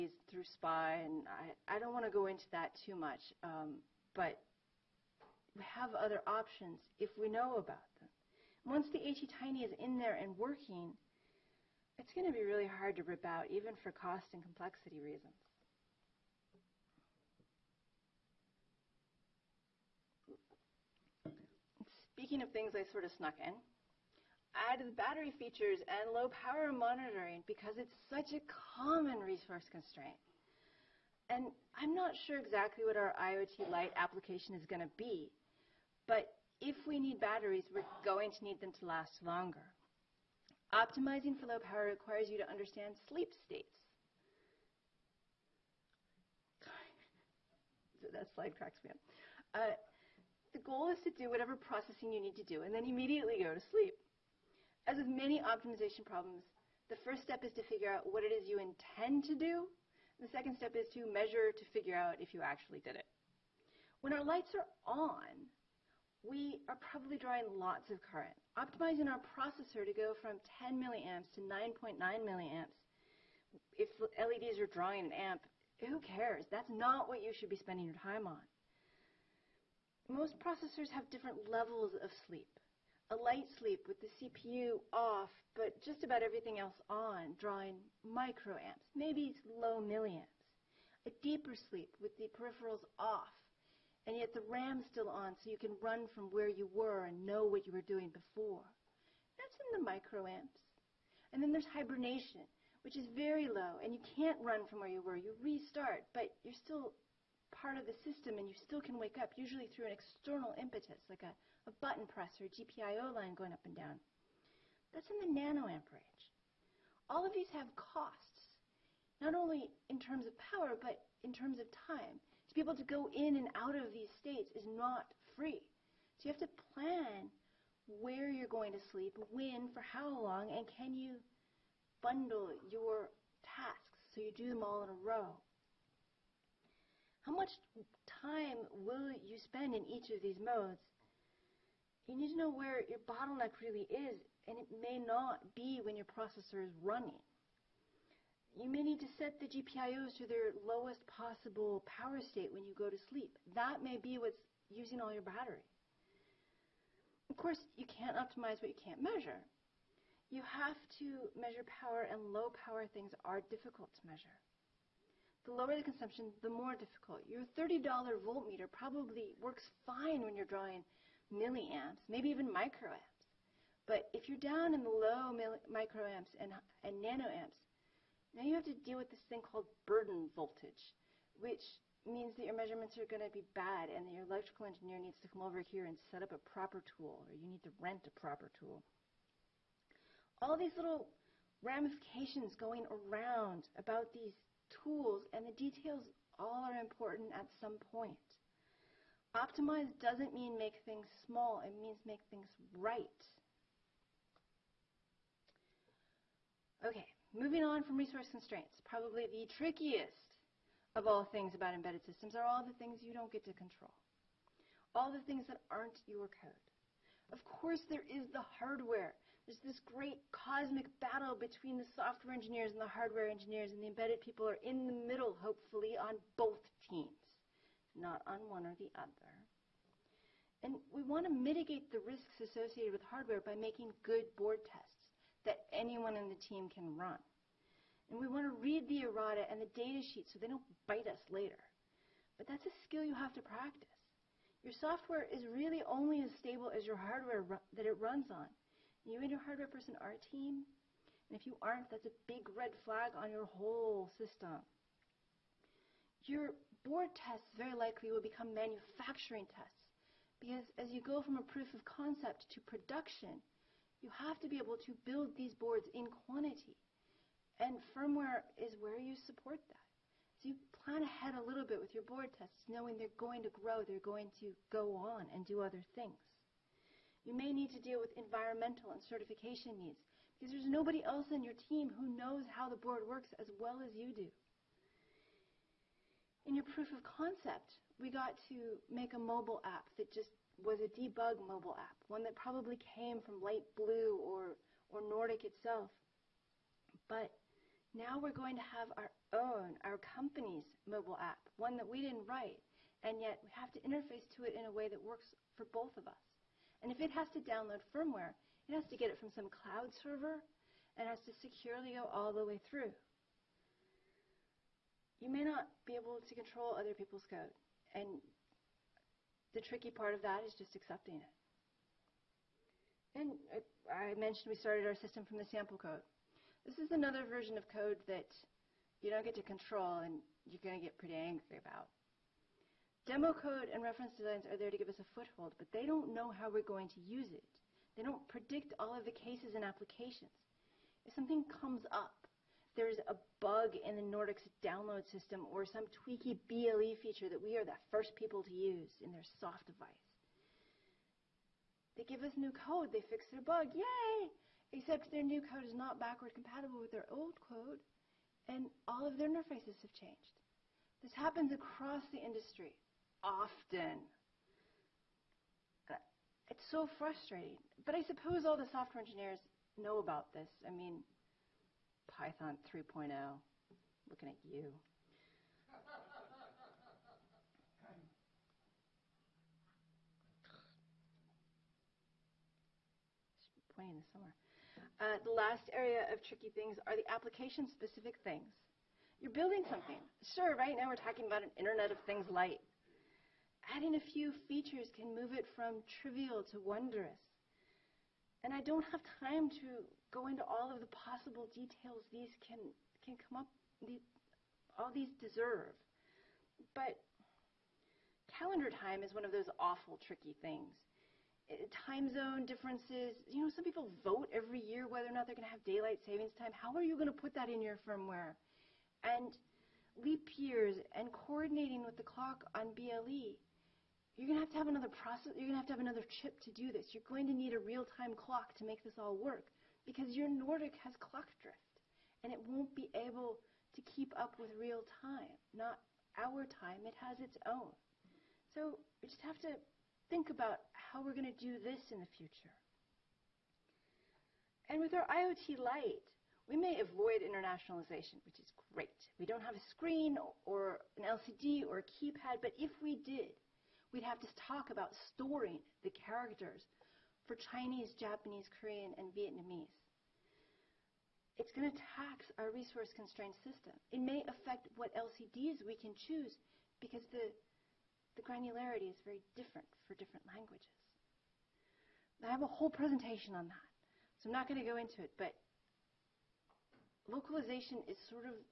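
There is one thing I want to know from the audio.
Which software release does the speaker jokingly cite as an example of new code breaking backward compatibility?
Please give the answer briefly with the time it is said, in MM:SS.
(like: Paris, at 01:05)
Python 3.0, at 06:12.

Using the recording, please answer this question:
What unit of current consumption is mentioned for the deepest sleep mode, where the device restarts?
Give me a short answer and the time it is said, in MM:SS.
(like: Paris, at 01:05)
nanoamperage, at 01:55.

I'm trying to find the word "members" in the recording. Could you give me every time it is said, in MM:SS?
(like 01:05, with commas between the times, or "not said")
not said.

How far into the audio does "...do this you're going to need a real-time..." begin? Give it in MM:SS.
07:06.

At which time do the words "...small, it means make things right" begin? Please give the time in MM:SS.
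03:21.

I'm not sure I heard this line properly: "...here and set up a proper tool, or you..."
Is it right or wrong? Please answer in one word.
right.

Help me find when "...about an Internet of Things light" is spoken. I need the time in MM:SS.
06:31.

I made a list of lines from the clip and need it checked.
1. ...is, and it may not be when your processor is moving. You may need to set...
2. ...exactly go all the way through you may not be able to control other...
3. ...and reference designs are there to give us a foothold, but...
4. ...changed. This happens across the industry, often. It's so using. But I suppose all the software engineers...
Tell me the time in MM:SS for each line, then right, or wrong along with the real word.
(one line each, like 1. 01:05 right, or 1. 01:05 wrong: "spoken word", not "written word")
1. 02:23 wrong: "running", not "moving"
2. 05:11 wrong: "securely", not "exactly"
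3. 05:33 right
4. 05:59 wrong: "frustrating", not "using".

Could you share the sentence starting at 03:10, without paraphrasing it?
All these little ramifications going around about these tools and the details all are important at some point.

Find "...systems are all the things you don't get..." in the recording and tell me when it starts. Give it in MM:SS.
03:32.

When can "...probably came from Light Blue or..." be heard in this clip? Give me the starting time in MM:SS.
04:52.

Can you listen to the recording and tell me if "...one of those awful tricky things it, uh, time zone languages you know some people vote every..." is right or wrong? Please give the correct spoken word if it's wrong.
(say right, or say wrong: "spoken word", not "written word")
wrong: "differences", not "languages".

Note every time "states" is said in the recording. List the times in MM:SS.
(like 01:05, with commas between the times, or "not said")
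00:43, 02:04, 02:32.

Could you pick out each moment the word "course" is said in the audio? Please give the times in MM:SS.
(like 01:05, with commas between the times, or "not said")
02:37, 03:37.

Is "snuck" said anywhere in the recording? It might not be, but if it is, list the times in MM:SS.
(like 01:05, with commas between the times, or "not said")
00:23.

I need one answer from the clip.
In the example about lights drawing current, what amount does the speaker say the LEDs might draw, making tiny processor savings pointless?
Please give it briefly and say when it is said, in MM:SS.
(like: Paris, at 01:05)
1 amp, at 01:15.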